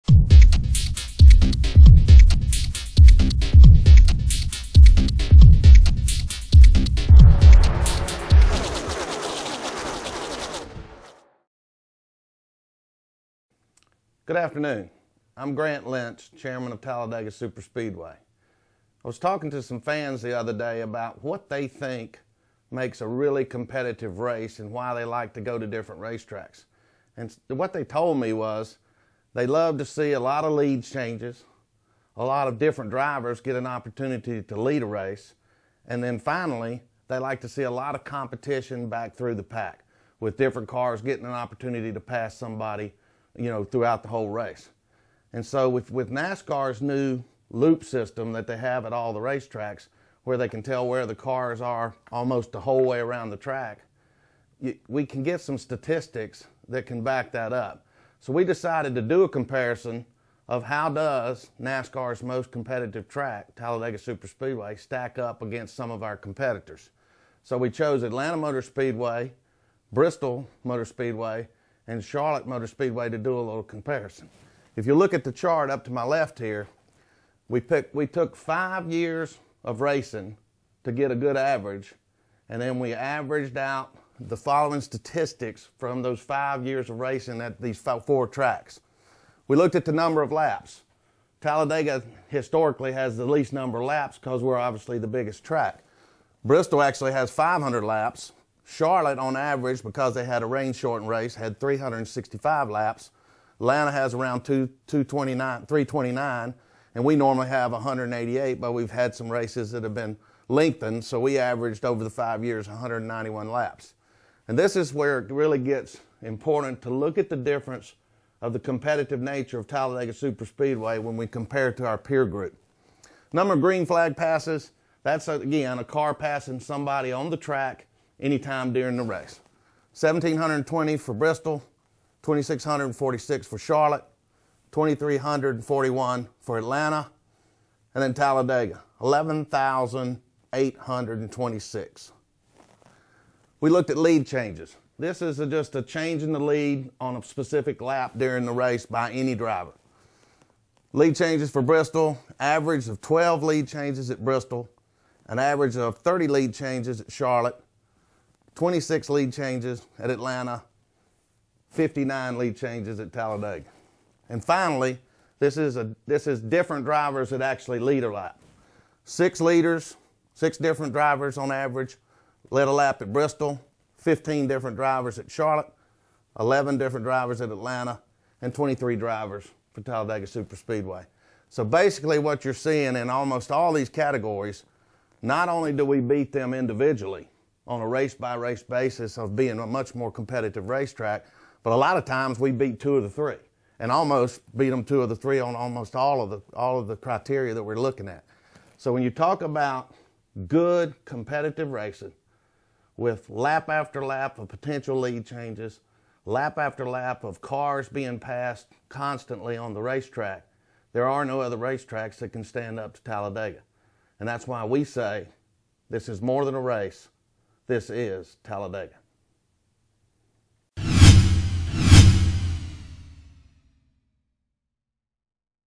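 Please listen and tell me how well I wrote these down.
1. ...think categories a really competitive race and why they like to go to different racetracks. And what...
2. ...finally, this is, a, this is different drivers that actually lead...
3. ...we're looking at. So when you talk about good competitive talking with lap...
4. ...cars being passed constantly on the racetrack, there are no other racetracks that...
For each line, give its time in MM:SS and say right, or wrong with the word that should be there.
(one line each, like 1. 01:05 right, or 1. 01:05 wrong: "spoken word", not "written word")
1. 00:21 wrong: "makes", not "categories"
2. 02:44 right
3. 03:17 wrong: "racing", not "talking"
4. 03:27 right.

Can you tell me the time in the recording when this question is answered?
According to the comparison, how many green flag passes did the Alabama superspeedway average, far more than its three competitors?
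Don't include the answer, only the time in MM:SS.
02:19.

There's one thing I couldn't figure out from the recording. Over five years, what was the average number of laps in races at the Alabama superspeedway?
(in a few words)
191.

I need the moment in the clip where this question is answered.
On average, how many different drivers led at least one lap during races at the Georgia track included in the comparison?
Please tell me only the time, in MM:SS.
02:56.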